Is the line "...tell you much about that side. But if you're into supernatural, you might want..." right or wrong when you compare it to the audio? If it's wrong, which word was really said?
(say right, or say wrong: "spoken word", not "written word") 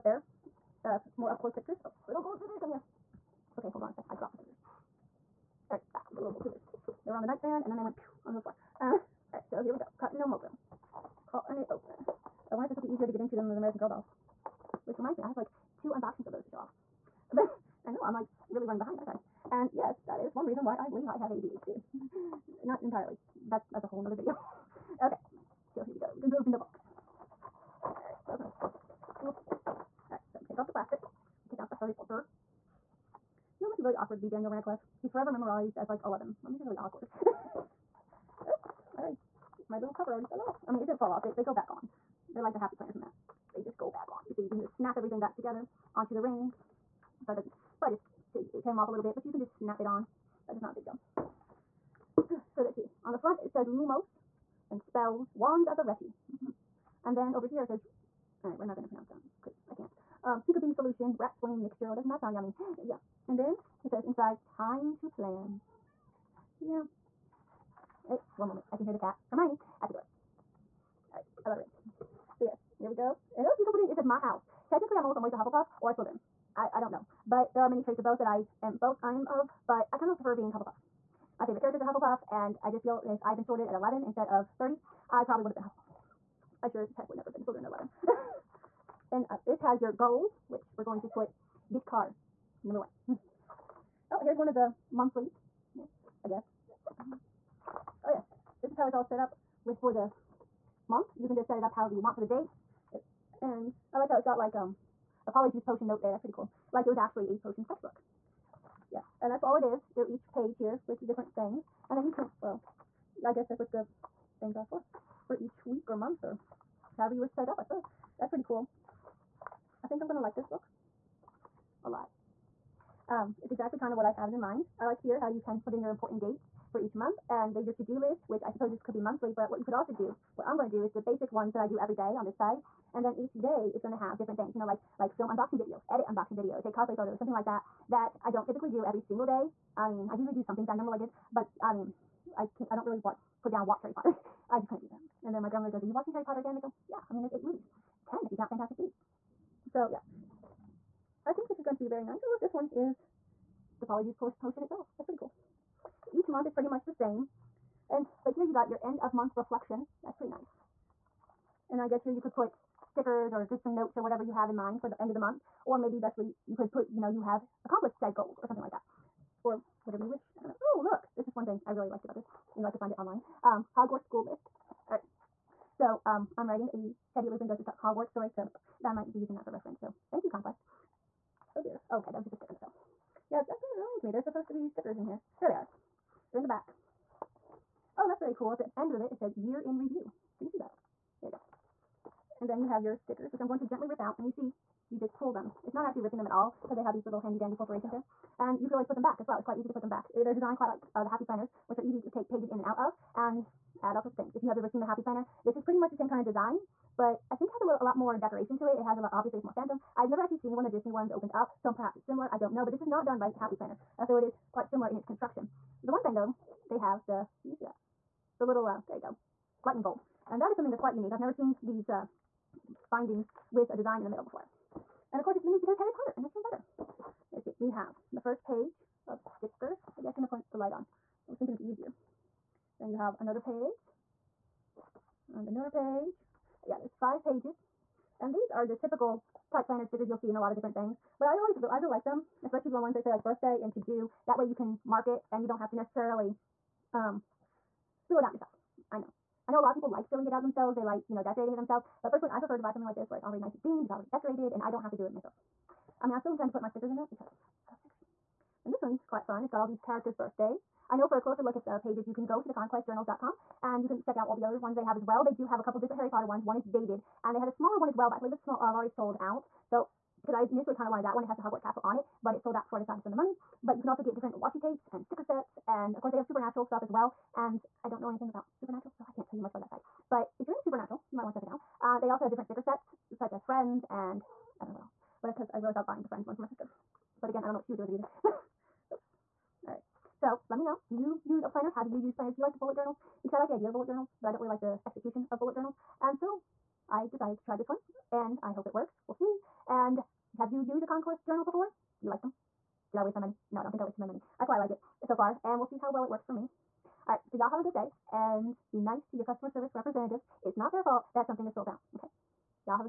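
right.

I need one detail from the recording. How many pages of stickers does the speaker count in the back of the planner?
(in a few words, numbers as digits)
5.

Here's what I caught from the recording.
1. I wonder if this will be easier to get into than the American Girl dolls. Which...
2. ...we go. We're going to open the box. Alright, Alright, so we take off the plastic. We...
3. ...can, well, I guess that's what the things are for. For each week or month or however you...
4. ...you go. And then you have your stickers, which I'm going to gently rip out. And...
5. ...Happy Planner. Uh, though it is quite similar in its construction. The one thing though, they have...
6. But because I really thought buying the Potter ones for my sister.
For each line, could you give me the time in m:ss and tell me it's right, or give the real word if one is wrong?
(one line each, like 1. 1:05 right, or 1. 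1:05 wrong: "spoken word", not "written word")
1. 0:12 right
2. 0:25 right
3. 1:52 right
4. 3:11 right
5. 3:33 right
6. 4:45 wrong: "Friends", not "Potter".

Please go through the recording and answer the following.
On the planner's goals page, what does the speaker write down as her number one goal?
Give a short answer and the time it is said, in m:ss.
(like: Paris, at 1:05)
Get car, at 1:31.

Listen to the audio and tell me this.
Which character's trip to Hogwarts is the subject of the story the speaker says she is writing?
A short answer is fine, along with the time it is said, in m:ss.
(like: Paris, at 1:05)
Teddy Lupin, at 2:57.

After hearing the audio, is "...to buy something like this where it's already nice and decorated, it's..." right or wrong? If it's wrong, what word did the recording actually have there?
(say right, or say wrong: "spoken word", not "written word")
wrong: "themed", not "decorated".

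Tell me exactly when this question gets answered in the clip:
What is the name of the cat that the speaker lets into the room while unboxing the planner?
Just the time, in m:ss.
1:09.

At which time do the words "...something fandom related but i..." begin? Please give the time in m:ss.
2:20.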